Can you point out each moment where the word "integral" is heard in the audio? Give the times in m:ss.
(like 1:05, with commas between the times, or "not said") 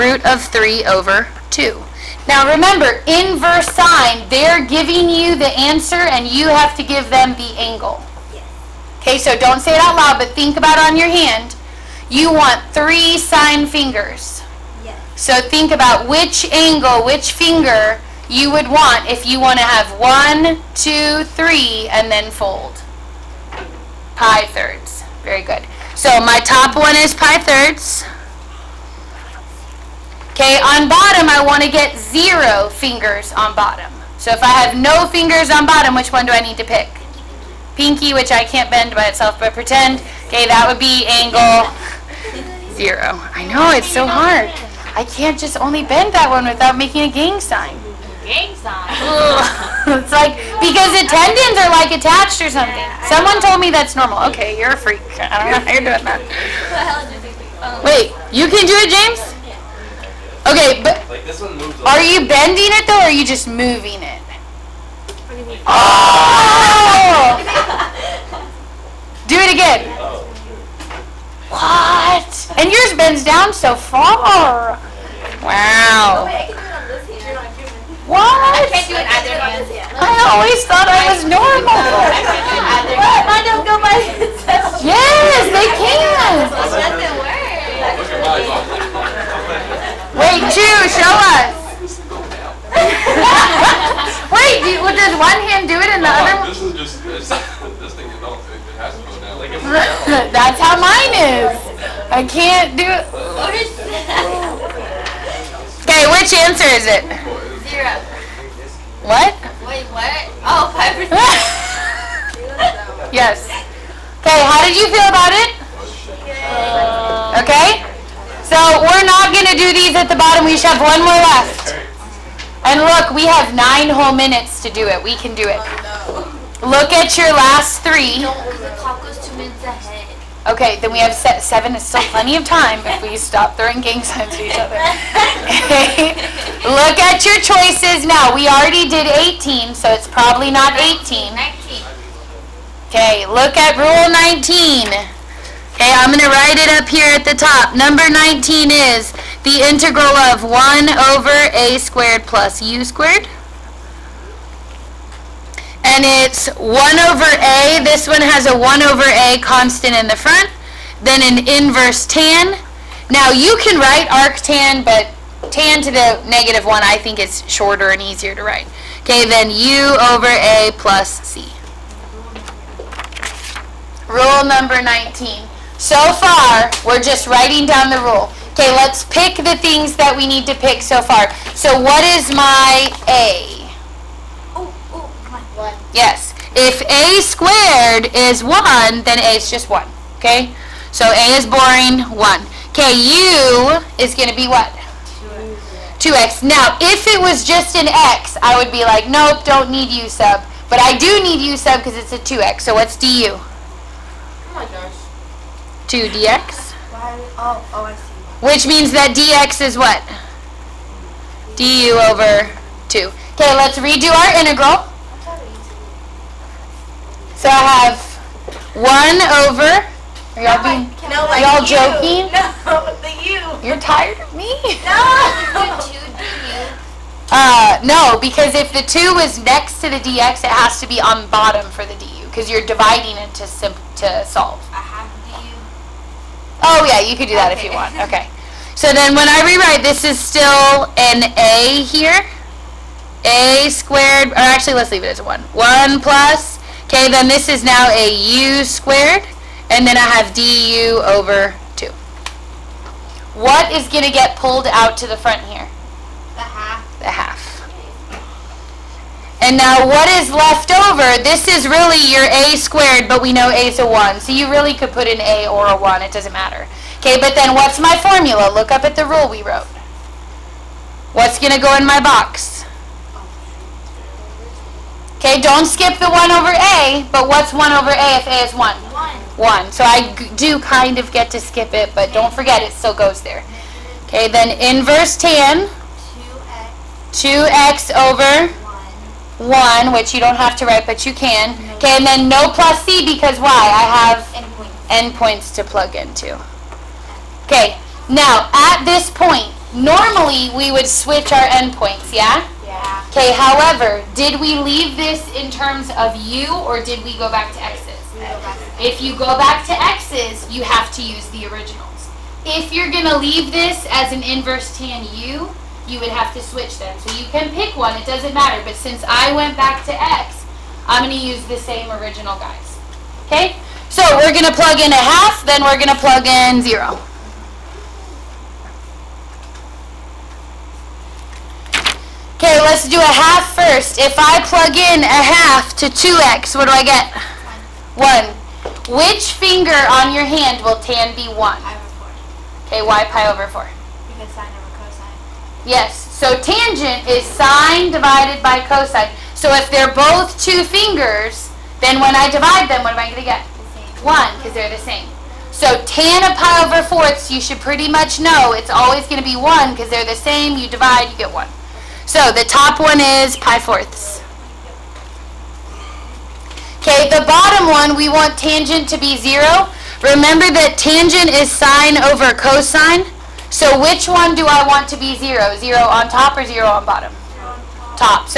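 2:29, 3:34.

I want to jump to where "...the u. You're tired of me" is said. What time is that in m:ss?
3:43.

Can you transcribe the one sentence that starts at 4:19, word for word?
And now what is left over, this is really your a squared, but we know a is a 1.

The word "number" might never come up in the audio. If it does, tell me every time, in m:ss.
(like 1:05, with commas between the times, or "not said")
2:27, 2:54.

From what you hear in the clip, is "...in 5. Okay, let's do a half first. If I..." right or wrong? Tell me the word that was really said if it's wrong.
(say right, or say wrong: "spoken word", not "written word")
wrong: "0", not "5".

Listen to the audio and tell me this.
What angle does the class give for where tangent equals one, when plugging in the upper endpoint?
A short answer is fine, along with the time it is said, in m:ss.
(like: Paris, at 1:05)
pi/4, at 5:43.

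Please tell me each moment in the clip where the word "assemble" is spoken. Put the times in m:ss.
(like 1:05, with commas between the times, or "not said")
not said.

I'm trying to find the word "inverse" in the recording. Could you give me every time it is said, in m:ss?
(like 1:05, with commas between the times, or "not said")
0:03, 2:41, 4:44, 5:14.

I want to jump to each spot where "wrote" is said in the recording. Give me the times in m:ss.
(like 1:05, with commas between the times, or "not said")
4:29.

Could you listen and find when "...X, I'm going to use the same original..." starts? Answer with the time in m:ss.
5:19.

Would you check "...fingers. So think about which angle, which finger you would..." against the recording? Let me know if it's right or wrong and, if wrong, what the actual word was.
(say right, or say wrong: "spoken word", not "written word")
right.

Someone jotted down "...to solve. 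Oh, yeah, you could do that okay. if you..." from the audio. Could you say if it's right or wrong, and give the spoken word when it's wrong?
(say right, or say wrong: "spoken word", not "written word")
right.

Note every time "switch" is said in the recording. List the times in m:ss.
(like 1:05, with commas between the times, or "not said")
5:00, 5:16.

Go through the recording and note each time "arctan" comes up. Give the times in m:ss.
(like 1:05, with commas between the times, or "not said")
2:44.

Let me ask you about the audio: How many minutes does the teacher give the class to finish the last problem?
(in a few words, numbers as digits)
9.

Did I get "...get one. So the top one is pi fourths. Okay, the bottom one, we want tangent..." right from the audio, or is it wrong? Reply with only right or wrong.
right.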